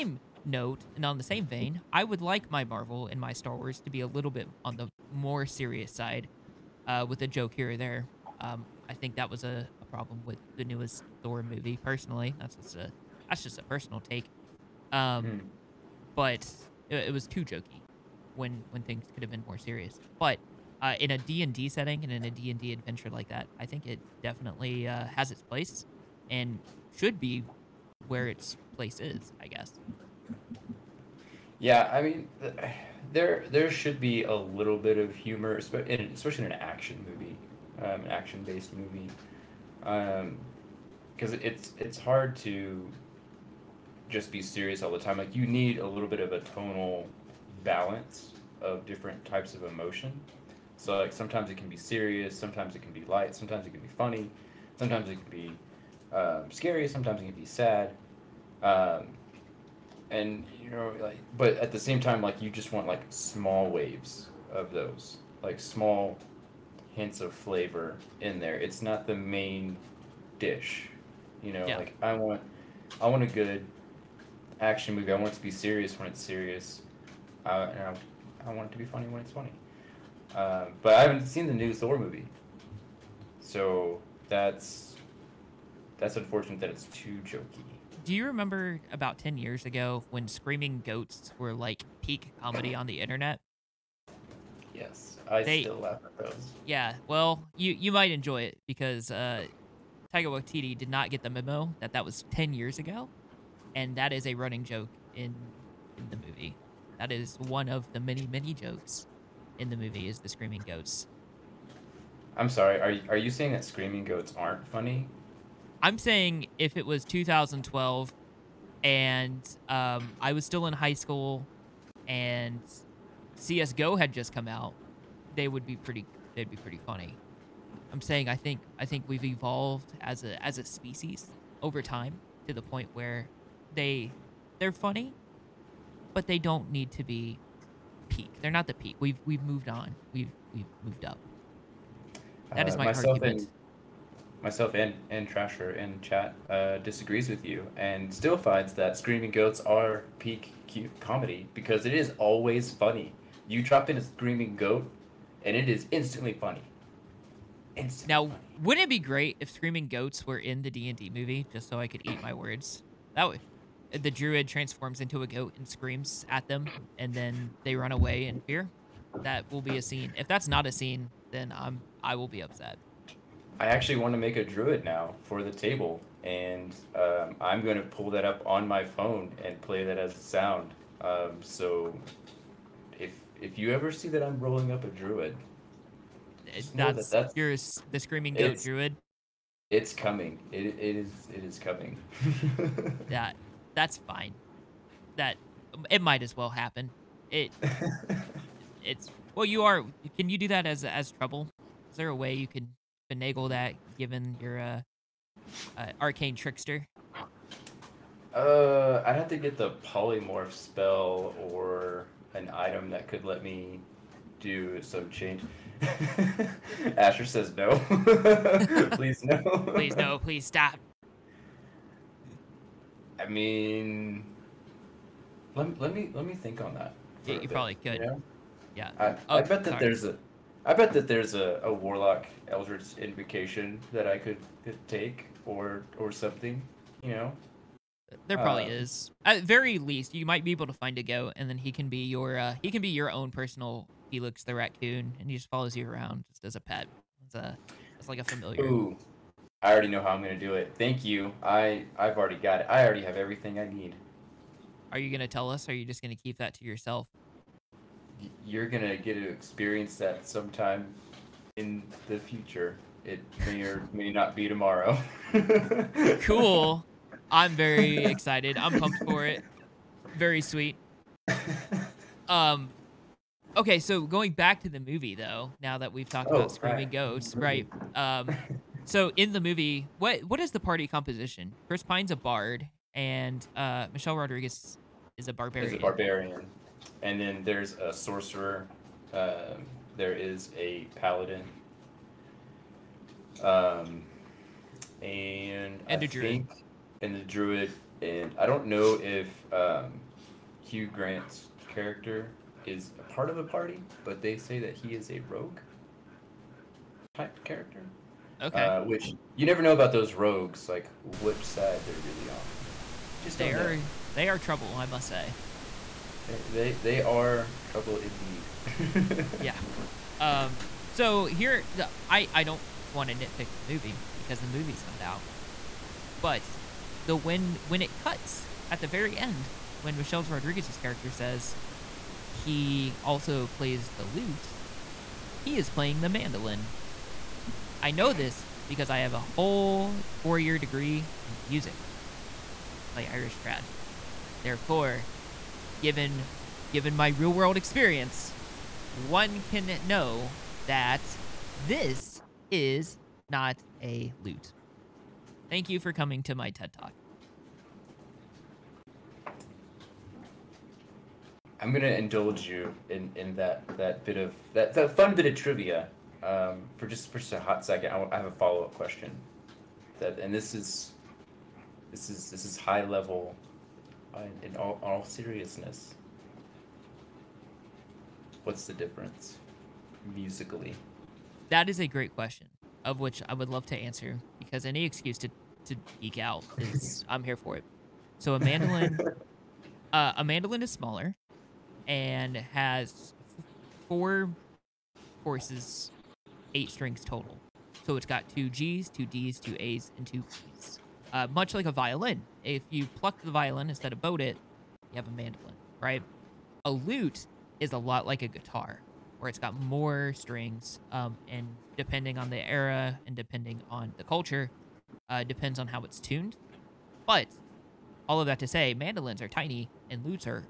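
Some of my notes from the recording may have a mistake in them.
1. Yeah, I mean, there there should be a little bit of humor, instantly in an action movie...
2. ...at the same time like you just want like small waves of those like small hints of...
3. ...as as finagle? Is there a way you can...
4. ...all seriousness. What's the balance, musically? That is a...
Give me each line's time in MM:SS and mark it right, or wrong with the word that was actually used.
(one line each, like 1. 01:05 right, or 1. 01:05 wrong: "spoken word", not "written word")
1. 00:31 wrong: "especially", not "instantly"
2. 01:01 right
3. 03:20 wrong: "trouble", not "finagle"
4. 06:14 wrong: "difference", not "balance".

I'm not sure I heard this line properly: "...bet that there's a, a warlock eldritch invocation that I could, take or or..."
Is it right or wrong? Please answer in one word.
right.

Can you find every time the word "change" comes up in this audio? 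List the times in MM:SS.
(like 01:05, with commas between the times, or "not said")
03:35.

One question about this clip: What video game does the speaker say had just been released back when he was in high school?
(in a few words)
CS:GO.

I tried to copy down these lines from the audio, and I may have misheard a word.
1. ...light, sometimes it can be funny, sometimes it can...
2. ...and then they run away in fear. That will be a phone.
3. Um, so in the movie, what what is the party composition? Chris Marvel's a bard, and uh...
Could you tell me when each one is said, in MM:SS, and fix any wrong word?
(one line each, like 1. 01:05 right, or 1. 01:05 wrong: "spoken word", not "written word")
1. 00:53 right
2. 02:46 wrong: "scene", not "phone"
3. 04:37 wrong: "Pine", not "Marvel".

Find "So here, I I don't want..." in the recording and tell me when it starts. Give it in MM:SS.
05:20.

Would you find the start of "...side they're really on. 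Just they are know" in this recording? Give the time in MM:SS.
05:11.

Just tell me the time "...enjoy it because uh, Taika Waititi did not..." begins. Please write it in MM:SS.
01:38.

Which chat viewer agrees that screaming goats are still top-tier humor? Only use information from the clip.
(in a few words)
Thrasher.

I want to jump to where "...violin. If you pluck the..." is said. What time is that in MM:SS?
06:41.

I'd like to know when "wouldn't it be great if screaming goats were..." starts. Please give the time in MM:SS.
02:38.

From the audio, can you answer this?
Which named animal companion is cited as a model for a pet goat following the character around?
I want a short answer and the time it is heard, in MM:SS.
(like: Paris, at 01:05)
Felix the raccoon, at 04:04.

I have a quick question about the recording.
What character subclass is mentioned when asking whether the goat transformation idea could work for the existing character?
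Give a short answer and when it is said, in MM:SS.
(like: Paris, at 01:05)
Arcane trickster, at 03:25.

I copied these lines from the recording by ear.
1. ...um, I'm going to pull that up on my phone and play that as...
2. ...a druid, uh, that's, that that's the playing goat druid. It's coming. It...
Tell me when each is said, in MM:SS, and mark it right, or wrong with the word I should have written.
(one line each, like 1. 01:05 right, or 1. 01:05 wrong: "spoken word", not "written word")
1. 02:56 right
2. 03:04 wrong: "screaming", not "playing".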